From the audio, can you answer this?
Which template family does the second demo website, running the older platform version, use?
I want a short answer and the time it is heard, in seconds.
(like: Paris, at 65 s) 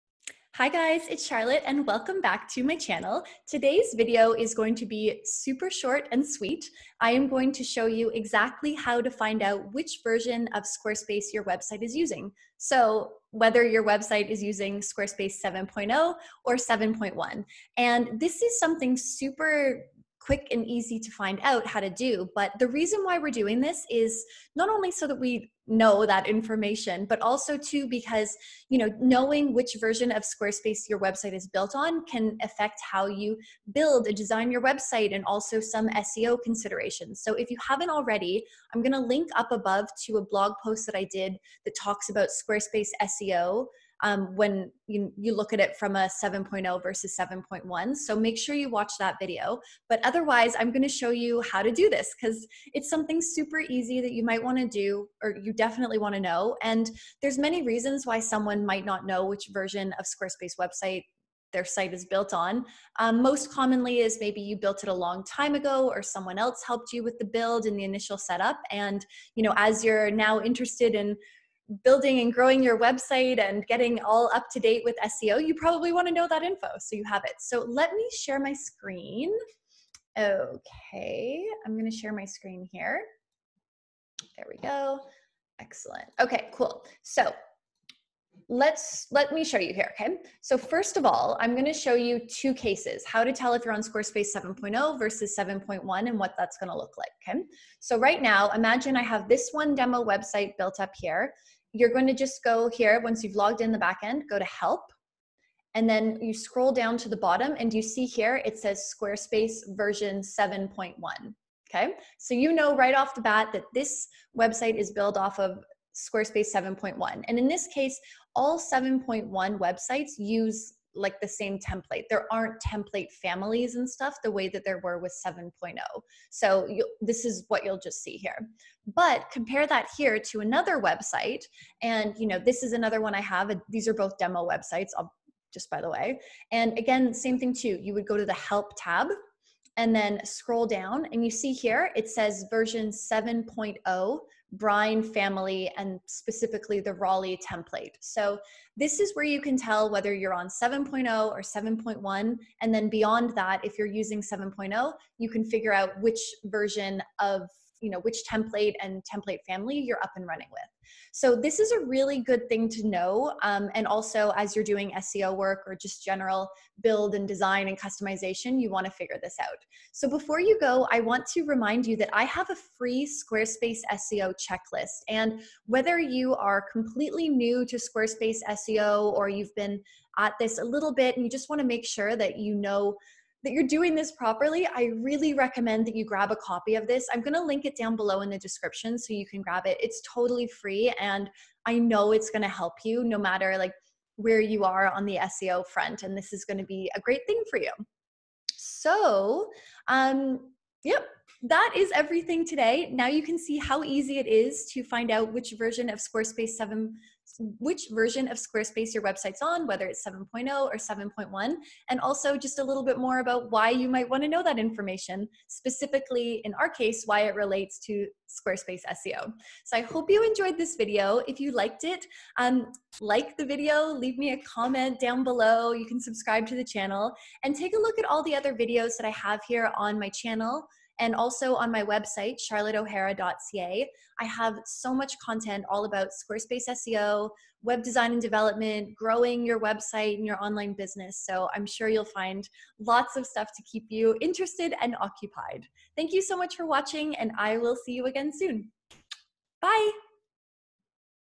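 Brine, at 144 s.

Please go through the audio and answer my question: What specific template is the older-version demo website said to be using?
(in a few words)
Raleigh.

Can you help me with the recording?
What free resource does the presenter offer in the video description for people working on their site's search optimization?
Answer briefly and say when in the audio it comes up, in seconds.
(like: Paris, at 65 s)
Squarespace SEO checklist, at 173 s.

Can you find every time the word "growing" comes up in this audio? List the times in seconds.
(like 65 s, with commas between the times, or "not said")
72 s, 238 s.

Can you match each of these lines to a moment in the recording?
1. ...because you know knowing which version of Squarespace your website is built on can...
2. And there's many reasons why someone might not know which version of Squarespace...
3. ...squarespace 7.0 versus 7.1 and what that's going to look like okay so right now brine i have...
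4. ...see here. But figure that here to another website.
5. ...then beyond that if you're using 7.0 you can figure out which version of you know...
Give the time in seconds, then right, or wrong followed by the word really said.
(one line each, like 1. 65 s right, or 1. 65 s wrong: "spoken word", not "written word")
1. 27 s right
2. 56 s right
3. 93 s wrong: "imagine", not "brine"
4. 128 s wrong: "compare", not "figure"
5. 152 s right.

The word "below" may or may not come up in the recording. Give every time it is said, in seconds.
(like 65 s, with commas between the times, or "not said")
187 s, 225 s.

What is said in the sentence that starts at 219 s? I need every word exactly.
So I hope you enjoyed this video.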